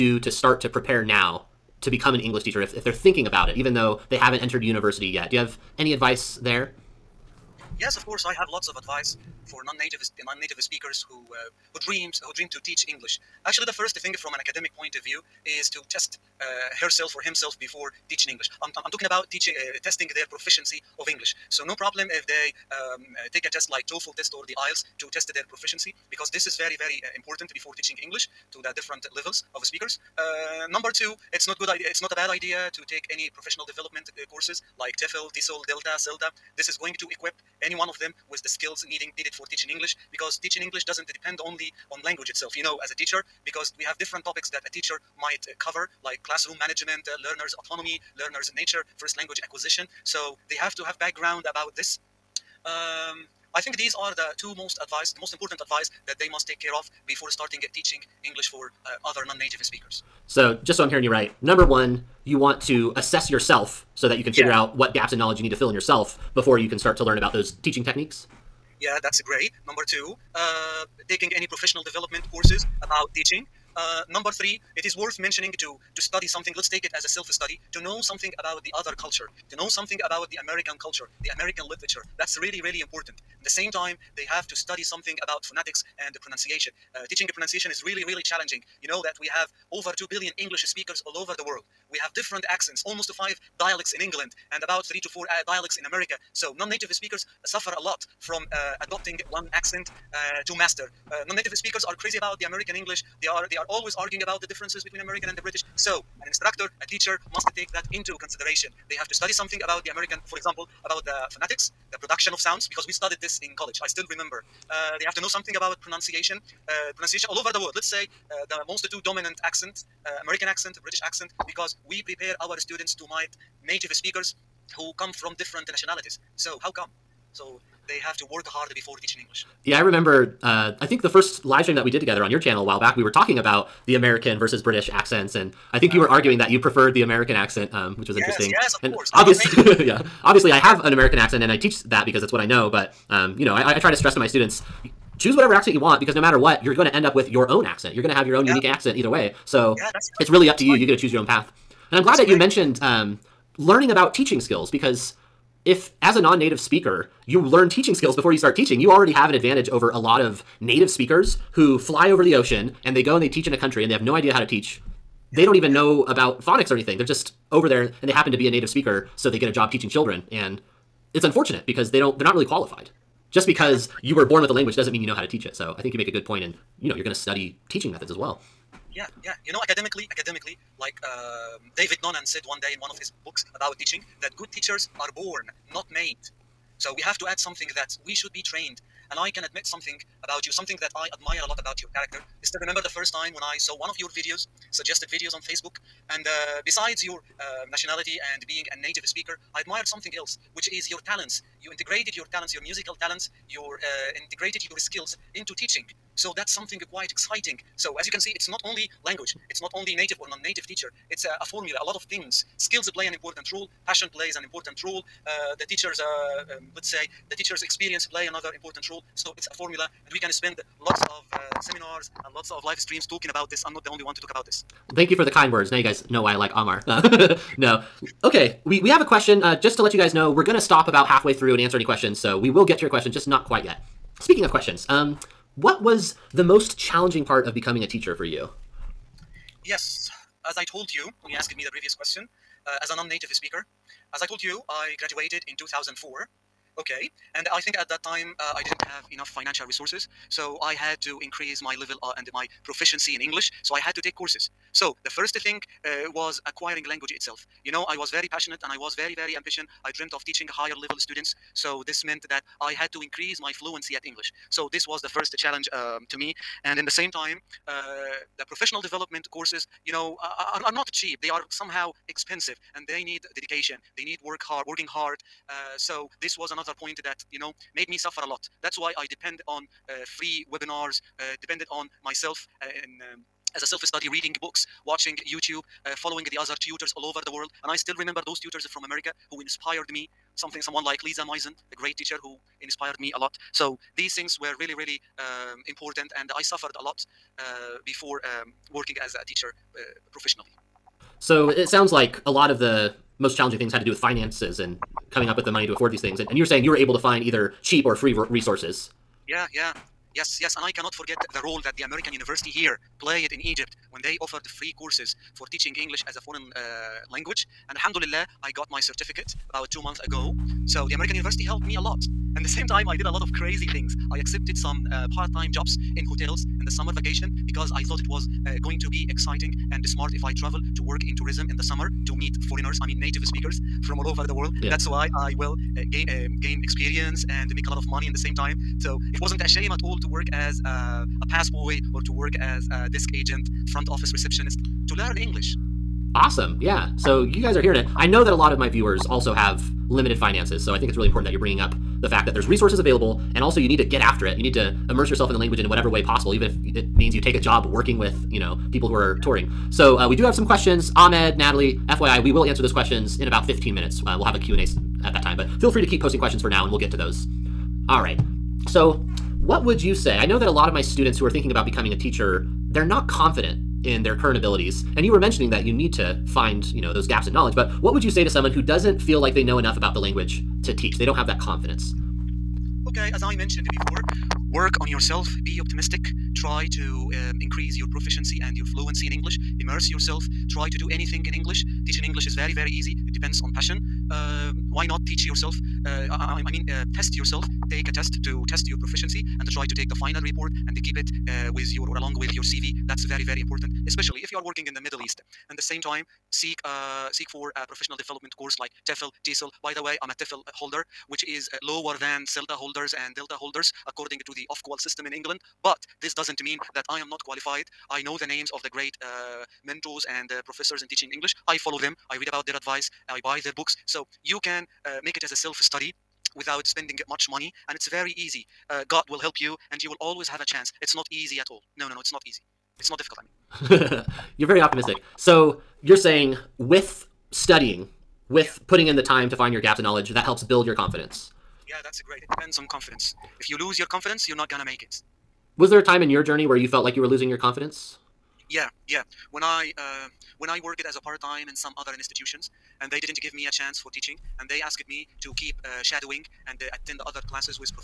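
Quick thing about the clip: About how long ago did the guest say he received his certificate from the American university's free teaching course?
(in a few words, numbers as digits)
two months ago.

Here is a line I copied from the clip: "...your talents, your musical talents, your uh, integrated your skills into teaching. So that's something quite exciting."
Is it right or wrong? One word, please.
right.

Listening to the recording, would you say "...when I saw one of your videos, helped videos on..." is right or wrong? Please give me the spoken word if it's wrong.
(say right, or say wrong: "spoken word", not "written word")
wrong: "suggested", not "helped".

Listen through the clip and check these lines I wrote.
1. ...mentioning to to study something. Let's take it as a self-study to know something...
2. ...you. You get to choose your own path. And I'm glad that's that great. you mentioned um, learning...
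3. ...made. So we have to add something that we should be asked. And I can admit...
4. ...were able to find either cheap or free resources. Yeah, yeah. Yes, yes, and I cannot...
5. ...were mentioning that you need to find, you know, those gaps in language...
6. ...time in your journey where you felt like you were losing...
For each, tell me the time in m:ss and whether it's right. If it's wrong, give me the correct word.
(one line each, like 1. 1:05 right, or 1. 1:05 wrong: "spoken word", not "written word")
1. 1:15 right
2. 2:30 right
3. 3:05 wrong: "trained", not "asked"
4. 5:06 right
5. 6:15 wrong: "knowledge", not "language"
6. 7:25 right.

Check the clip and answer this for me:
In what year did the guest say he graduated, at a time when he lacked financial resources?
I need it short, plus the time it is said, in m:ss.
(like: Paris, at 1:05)
2004, at 4:05.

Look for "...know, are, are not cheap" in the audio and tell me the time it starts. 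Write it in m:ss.
4:29.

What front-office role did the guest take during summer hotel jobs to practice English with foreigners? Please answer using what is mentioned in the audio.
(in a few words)
desk agent.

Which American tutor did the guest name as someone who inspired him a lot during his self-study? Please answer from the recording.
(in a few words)
Lisa Mojsin.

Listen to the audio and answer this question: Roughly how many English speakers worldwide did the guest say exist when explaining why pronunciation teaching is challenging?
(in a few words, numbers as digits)
over 2 billion.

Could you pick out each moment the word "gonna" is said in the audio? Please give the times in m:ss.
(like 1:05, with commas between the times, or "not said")
3:50, 7:24.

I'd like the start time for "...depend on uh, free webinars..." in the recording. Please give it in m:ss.
4:39.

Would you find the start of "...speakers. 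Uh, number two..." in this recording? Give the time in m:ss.
0:29.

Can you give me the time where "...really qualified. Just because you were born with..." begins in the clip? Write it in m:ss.
2:52.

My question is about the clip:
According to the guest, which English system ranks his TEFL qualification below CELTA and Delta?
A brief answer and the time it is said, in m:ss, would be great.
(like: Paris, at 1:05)
Ofqual, at 6:54.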